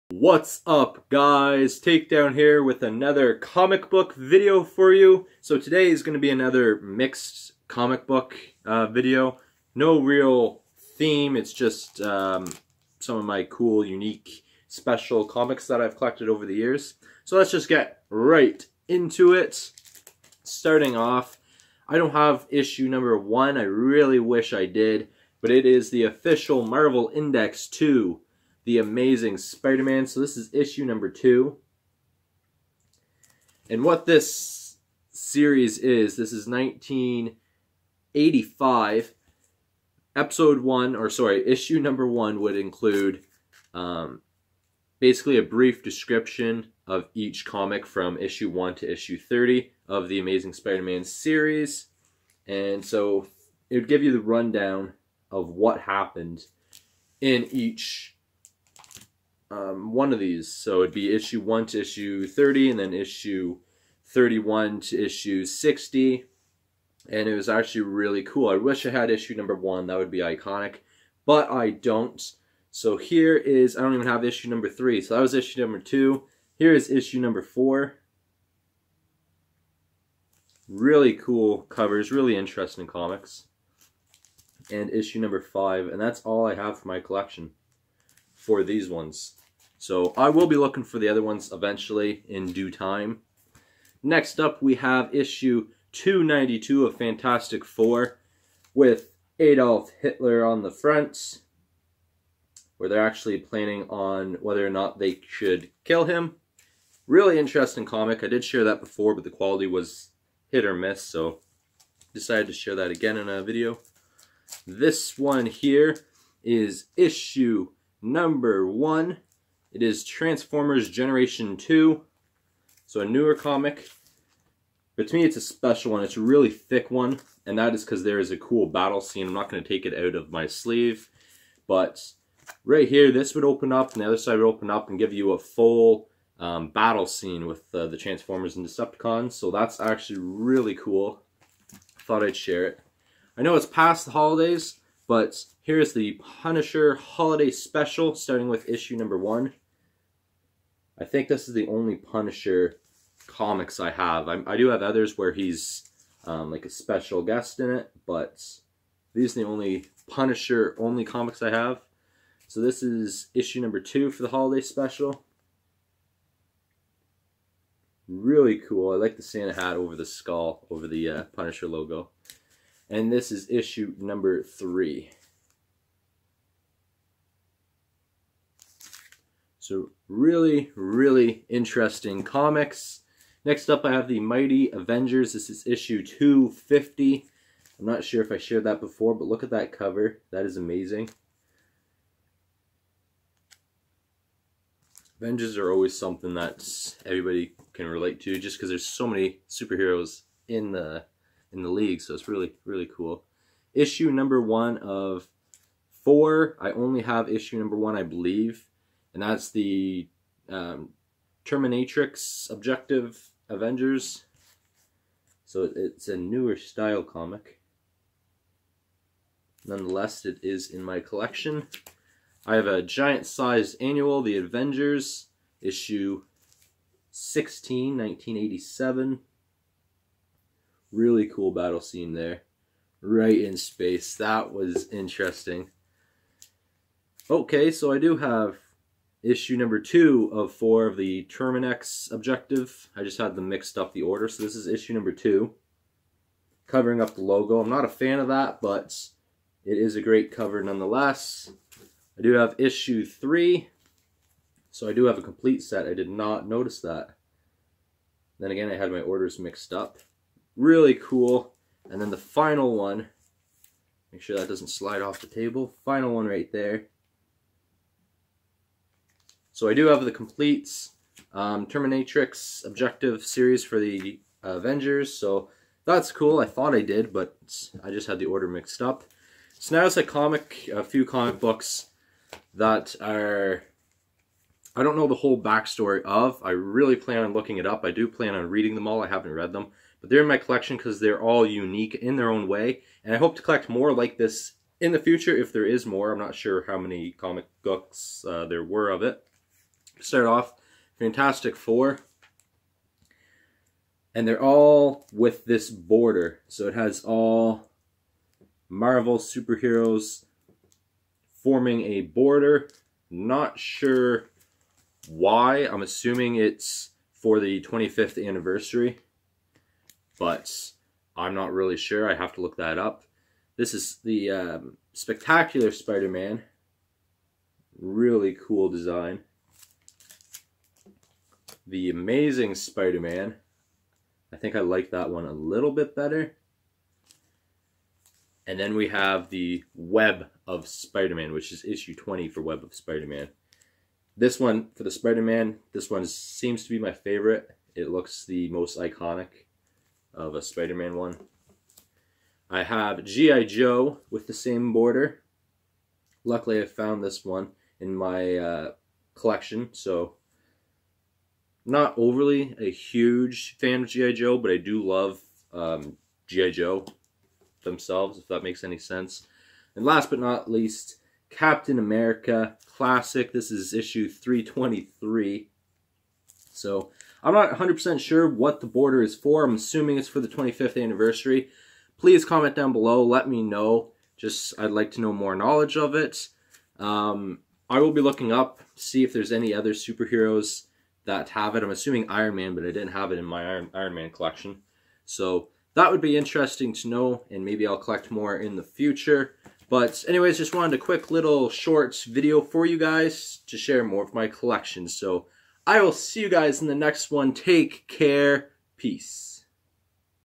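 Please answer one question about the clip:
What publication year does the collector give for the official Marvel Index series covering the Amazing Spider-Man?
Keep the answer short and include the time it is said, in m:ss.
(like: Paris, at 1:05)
1985, at 0:36.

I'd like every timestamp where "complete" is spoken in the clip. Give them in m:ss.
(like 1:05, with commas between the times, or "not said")
4:15, 4:30.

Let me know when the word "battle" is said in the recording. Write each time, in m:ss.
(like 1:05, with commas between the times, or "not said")
2:08, 2:16, 3:51.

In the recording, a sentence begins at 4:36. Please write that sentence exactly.
I thought I did, but I just had the order mixed up.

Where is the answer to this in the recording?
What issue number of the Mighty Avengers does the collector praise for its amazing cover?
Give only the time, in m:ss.
3:06.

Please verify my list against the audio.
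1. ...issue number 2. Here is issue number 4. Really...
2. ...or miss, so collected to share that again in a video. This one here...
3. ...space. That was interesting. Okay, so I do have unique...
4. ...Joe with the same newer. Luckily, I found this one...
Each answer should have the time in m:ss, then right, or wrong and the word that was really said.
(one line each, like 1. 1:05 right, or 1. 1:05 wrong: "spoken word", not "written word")
1. 1:15 right
2. 1:50 wrong: "decided", not "collected"
3. 3:53 wrong: "issue", not "unique"
4. 5:53 wrong: "border", not "newer".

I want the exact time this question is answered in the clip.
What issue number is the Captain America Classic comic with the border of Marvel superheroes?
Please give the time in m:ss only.
6:14.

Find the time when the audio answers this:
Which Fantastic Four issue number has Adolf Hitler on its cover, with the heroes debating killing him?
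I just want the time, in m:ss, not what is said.
1:35.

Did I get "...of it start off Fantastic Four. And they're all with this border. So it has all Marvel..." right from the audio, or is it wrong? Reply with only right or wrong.
right.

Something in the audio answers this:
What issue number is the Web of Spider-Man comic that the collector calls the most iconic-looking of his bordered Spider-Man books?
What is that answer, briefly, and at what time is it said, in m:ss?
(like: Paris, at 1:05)
20, at 5:41.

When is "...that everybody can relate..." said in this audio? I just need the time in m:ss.
3:16.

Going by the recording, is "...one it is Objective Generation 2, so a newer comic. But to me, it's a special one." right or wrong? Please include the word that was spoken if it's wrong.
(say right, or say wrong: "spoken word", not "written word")
wrong: "Transformers", not "Objective".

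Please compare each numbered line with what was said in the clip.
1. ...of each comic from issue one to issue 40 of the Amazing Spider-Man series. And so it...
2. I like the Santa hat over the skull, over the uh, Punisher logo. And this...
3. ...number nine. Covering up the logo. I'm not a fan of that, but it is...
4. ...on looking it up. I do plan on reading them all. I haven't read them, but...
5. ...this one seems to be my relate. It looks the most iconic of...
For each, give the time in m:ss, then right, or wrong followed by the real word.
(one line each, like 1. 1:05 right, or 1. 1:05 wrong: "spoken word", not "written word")
1. 0:46 wrong: "30", not "40"
2. 2:48 right
3. 4:04 wrong: "two", not "nine"
4. 4:47 right
5. 5:45 wrong: "favorite", not "relate".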